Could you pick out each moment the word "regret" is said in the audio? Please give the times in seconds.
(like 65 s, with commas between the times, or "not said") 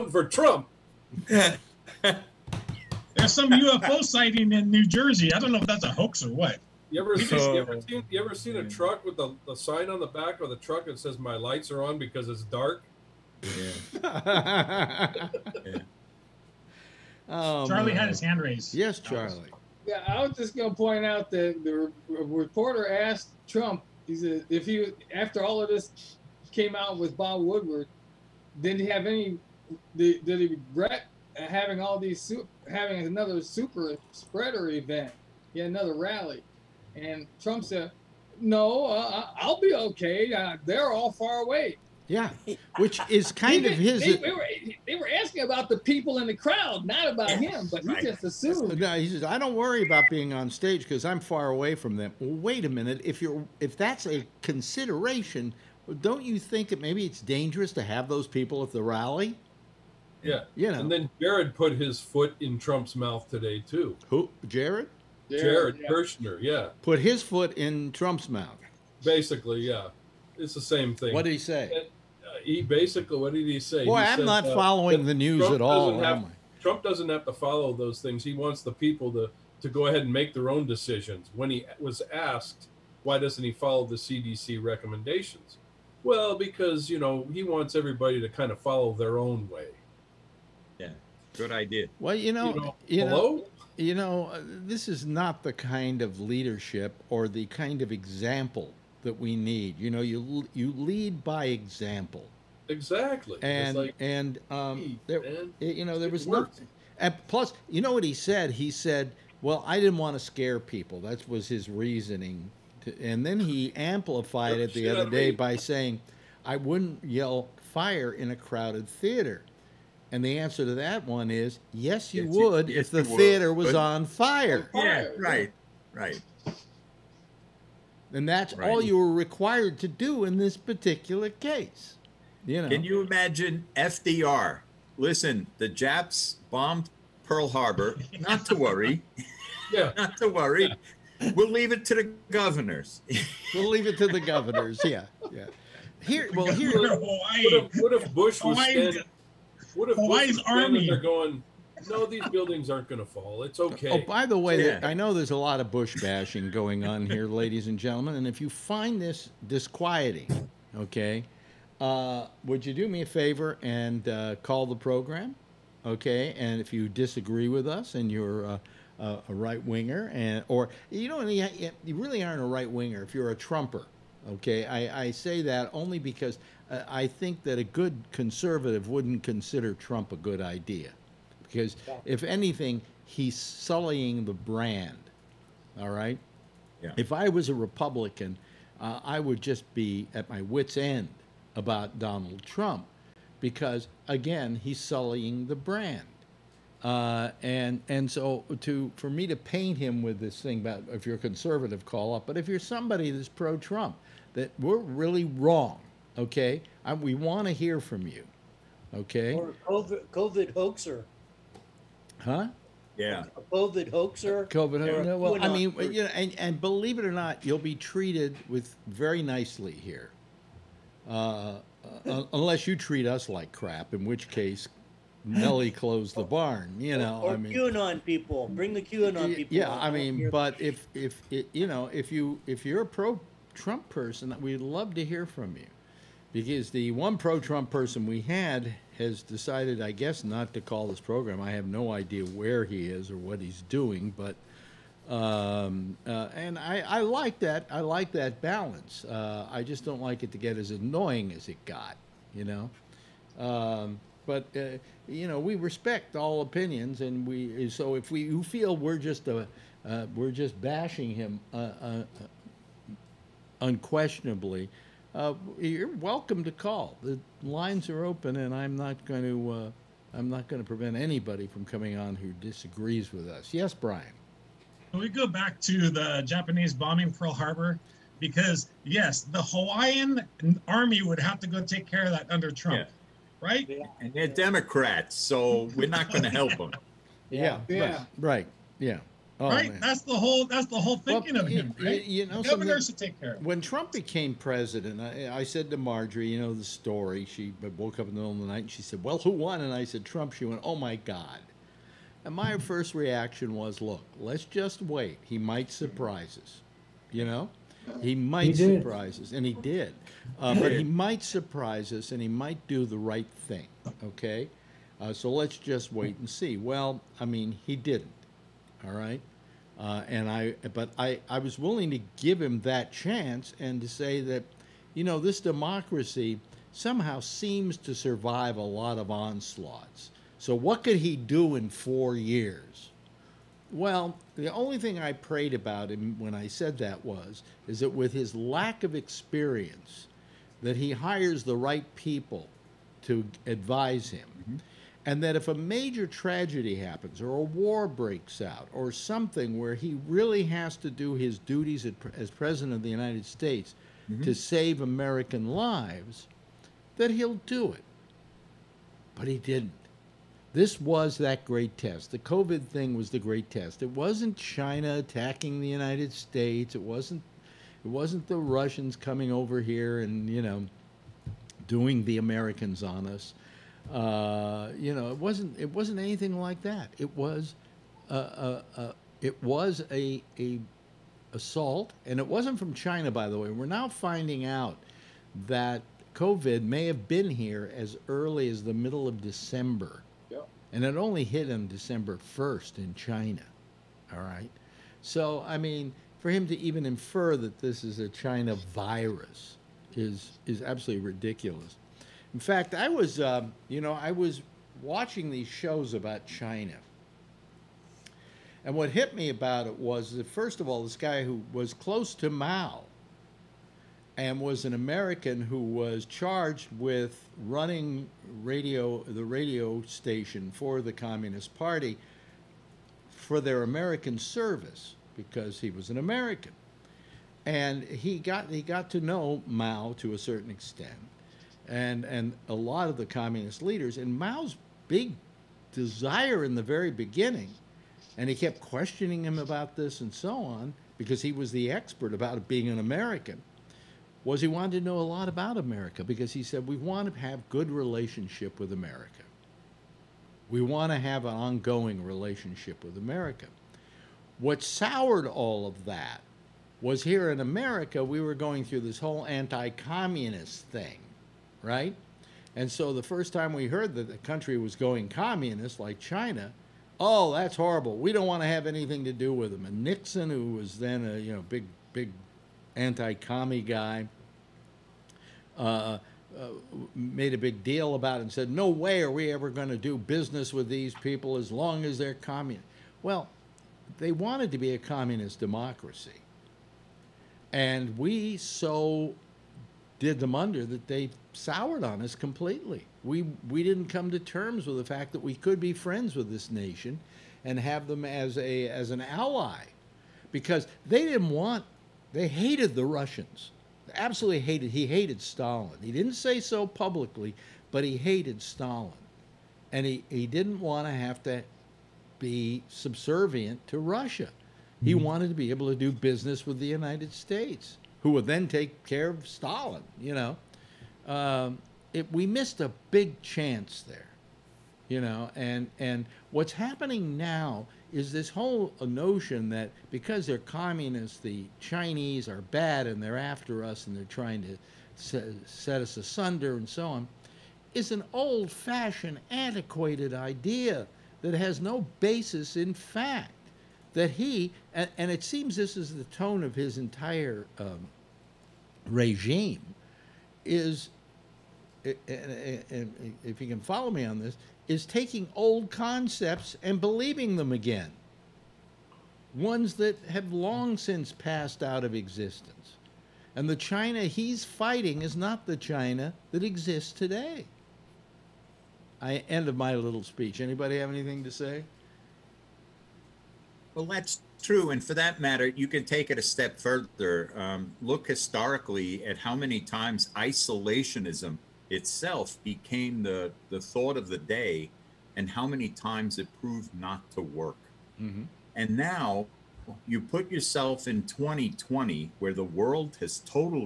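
30 s.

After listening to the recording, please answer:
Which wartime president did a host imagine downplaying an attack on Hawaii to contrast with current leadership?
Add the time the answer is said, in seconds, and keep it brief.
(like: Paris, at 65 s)
FDR, at 133 s.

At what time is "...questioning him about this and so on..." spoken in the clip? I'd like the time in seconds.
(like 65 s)
438 s.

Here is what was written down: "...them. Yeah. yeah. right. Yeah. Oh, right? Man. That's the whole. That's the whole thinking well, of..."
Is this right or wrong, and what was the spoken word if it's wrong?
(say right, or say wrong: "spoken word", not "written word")
right.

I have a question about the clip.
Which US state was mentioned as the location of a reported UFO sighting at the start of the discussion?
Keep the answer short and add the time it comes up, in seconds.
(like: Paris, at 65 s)
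New Jersey, at 4 s.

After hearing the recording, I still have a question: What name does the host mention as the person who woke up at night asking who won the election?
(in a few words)
Marjorie.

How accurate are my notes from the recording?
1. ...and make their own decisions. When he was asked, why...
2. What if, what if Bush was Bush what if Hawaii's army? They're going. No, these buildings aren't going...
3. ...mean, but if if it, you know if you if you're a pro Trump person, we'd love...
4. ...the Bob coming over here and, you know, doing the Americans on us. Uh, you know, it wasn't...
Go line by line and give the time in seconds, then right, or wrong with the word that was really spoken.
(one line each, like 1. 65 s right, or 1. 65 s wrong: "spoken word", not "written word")
1. 80 s right
2. 146 s wrong: "Hawaii", not "Bush"
3. 229 s right
4. 368 s wrong: "Russians", not "Bob".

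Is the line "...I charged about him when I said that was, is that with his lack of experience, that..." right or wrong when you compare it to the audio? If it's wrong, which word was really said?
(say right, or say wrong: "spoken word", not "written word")
wrong: "prayed", not "charged".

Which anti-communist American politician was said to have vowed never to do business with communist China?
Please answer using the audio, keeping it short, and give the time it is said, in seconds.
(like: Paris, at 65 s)
Nixon, at 469 s.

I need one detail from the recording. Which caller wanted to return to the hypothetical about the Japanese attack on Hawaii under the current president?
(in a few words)
Brian.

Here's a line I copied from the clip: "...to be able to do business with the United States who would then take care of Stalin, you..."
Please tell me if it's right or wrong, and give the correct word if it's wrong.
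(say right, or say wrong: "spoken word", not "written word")
right.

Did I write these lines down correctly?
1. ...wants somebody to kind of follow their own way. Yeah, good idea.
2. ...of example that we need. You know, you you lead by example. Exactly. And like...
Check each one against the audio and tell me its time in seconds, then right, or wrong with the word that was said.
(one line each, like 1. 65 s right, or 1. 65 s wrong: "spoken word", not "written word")
1. 87 s wrong: "everybody", not "somebody"
2. 97 s right.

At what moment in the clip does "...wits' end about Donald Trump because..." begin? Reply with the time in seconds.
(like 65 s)
190 s.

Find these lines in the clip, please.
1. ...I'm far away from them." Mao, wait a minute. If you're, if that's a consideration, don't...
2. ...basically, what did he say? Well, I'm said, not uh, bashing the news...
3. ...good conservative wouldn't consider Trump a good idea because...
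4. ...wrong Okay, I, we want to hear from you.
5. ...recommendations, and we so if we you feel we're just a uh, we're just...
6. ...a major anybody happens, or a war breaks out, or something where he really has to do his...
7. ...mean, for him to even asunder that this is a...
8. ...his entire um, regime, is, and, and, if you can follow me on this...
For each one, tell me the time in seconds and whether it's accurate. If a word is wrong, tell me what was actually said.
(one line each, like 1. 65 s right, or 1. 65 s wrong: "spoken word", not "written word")
1. 51 s wrong: "Well", not "Mao"
2. 72 s wrong: "following", not "bashing"
3. 177 s right
4. 205 s right
5. 256 s wrong: "opinions", not "recommendations"
6. 345 s wrong: "tragedy", not "anybody"
7. 395 s wrong: "infer", not "asunder"
8. 546 s right.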